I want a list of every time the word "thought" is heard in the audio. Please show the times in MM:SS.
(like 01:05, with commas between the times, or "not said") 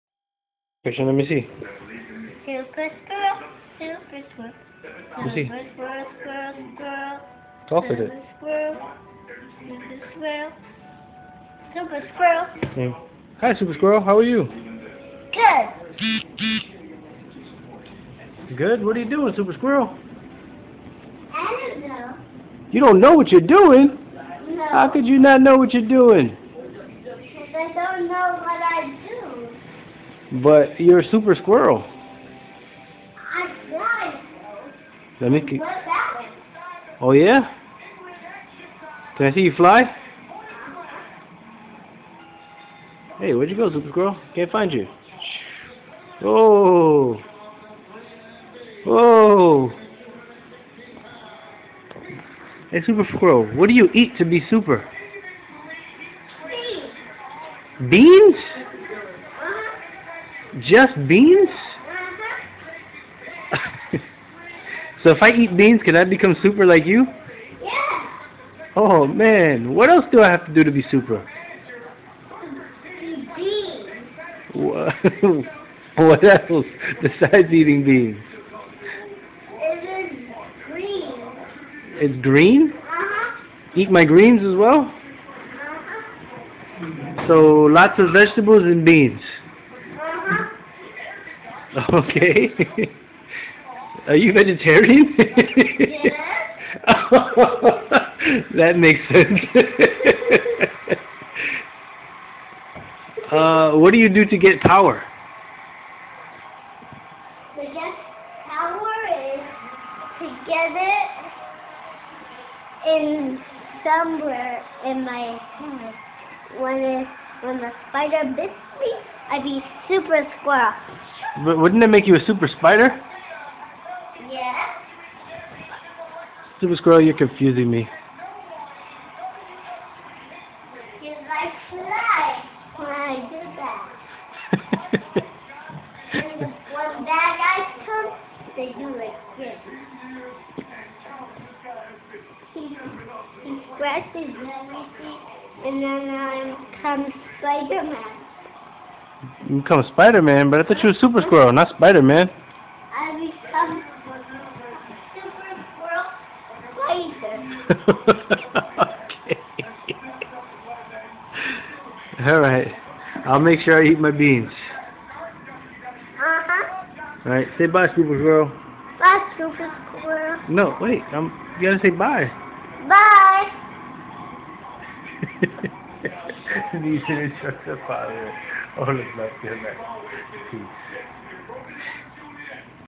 02:30.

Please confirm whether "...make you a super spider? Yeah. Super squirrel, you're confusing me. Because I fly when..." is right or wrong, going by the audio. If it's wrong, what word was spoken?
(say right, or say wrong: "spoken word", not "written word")
right.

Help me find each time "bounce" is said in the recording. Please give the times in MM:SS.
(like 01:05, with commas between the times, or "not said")
not said.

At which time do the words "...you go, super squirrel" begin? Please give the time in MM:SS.
00:43.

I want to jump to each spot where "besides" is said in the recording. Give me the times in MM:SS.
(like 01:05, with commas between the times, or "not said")
01:17.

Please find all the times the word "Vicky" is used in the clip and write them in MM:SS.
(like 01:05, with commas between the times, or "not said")
not said.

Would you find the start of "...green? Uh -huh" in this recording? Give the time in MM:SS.
01:22.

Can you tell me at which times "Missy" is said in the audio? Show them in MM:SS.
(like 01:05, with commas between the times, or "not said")
00:01, 00:05.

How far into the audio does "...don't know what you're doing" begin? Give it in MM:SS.
00:22.